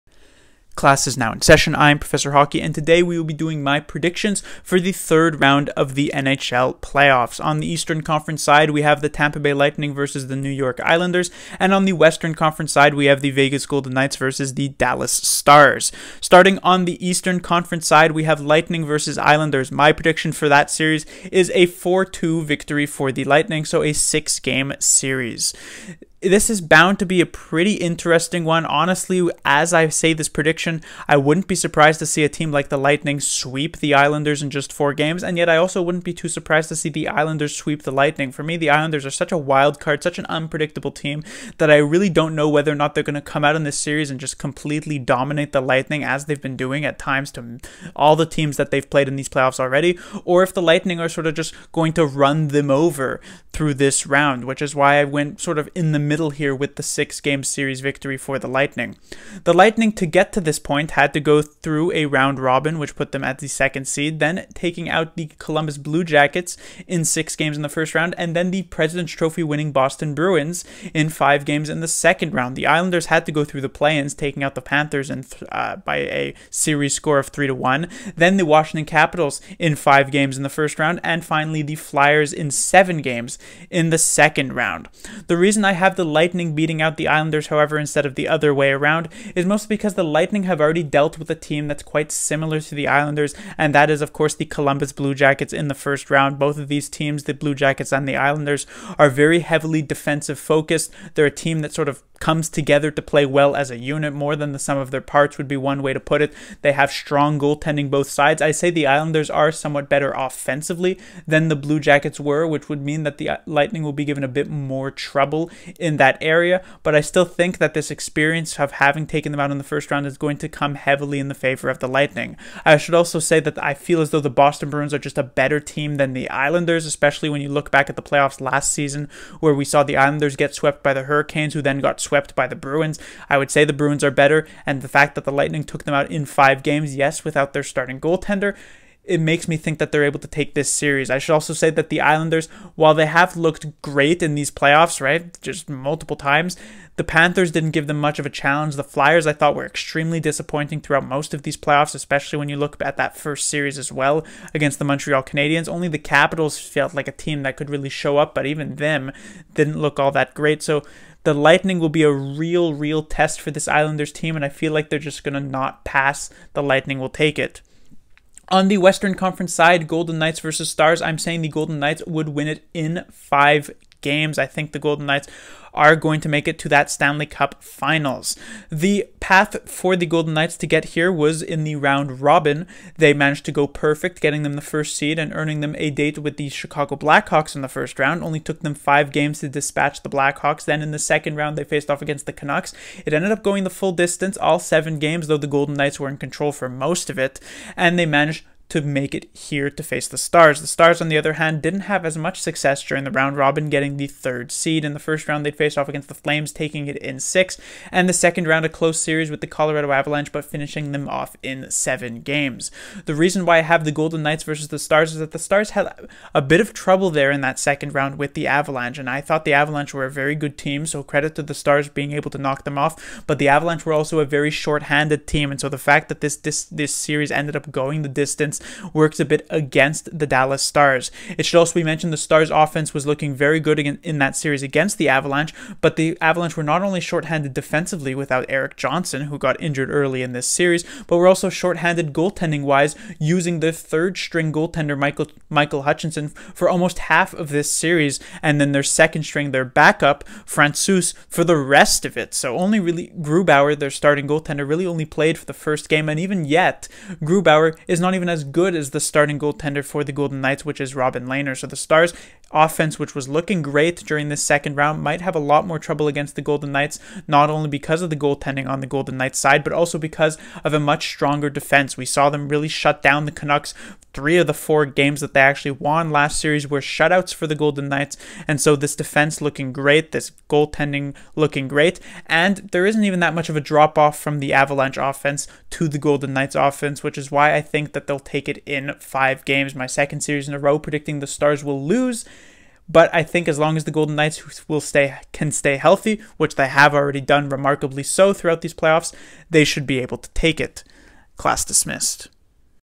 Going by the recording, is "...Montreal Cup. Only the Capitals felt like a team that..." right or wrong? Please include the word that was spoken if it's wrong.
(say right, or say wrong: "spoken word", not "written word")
wrong: "Canadiens", not "Cup".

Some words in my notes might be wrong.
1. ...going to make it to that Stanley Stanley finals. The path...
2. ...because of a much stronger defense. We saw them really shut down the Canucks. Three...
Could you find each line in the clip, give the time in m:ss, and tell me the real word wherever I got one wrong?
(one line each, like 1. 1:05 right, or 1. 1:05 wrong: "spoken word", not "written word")
1. 2:55 wrong: "Cup", not "Stanley"
2. 4:29 right.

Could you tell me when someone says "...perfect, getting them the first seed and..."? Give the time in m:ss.
3:03.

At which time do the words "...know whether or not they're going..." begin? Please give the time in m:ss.
0:42.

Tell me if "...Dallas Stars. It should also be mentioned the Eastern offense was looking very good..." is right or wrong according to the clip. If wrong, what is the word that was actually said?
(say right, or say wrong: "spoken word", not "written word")
wrong: "Stars", not "Eastern".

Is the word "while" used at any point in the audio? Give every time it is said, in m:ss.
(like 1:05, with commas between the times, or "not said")
2:22.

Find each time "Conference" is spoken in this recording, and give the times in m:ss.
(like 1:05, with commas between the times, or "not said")
0:08, 0:12, 0:17, 2:49.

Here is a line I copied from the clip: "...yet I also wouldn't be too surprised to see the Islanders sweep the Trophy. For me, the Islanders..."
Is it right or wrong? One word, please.
wrong.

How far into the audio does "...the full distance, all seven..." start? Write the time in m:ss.
3:13.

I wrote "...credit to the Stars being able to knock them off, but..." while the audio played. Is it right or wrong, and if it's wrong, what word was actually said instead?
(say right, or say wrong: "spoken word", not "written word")
right.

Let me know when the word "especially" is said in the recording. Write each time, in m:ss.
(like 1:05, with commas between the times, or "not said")
2:06, 2:31.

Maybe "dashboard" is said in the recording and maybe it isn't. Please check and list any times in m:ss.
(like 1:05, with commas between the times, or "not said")
not said.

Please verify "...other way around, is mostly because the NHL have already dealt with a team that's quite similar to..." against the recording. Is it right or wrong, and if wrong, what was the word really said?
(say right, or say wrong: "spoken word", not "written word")
wrong: "Lightning", not "NHL".